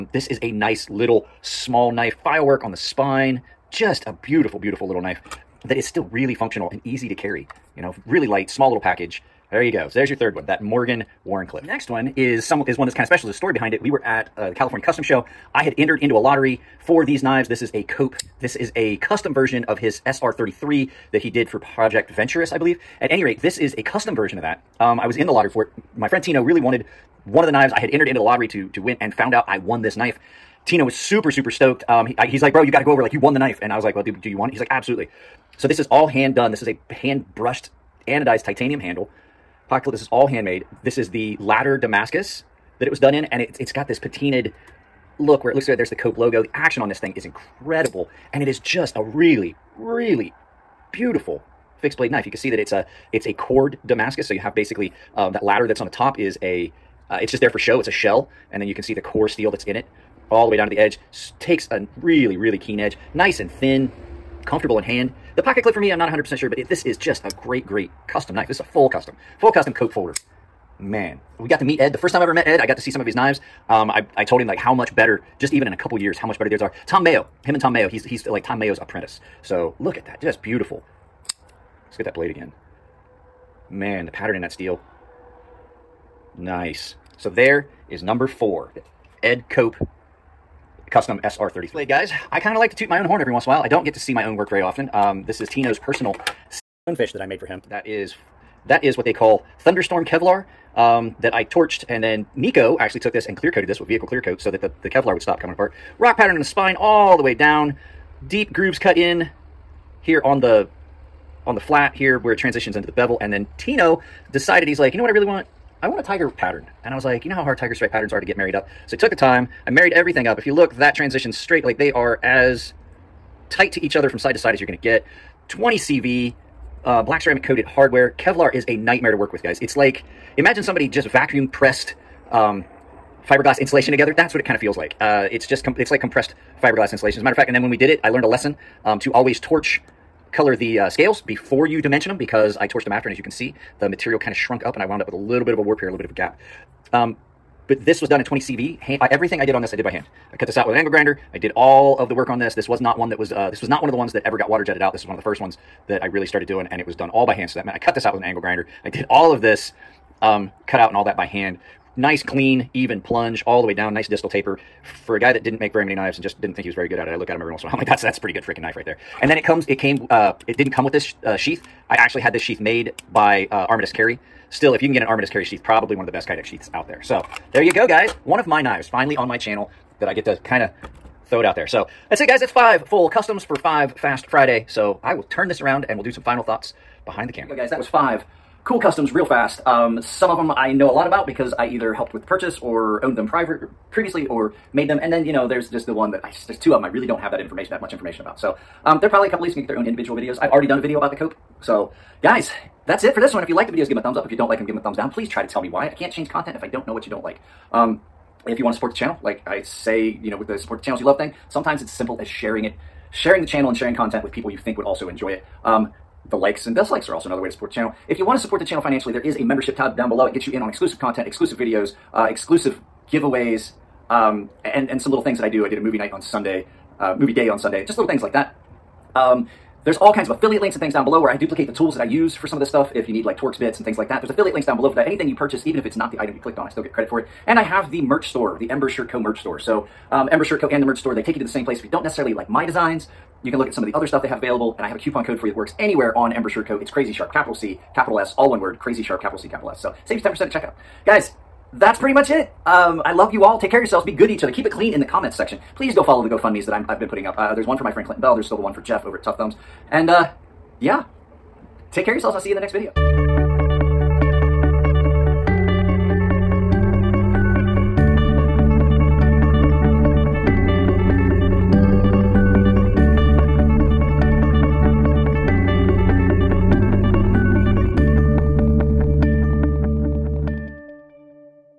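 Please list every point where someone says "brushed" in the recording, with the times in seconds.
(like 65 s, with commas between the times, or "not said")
37 s.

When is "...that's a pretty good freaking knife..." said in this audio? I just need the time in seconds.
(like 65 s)
168 s.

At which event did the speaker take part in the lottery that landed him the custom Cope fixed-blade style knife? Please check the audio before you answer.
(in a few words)
California Custom Show.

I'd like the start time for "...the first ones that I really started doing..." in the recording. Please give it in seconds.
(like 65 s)
155 s.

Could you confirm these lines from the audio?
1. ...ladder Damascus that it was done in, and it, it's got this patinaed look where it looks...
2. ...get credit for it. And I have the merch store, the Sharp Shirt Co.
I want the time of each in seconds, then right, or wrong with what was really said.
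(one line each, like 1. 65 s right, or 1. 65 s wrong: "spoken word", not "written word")
1. 41 s right
2. 236 s wrong: "Ember", not "Sharp".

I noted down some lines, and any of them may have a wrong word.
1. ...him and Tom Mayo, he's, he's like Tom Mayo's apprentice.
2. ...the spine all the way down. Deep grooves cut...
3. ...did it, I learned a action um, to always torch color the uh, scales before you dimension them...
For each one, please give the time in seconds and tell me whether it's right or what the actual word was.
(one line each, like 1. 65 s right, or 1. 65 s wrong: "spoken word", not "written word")
1. 77 s right
2. 106 s right
3. 137 s wrong: "lesson", not "action".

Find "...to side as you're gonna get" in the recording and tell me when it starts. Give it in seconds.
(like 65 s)
124 s.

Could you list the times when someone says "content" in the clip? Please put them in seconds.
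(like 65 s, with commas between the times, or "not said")
206 s, 213 s, 220 s.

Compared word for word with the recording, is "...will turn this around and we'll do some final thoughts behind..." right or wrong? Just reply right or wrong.
right.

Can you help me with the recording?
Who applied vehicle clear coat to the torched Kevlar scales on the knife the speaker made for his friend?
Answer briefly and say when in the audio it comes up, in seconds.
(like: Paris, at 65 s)
Nico, at 102 s.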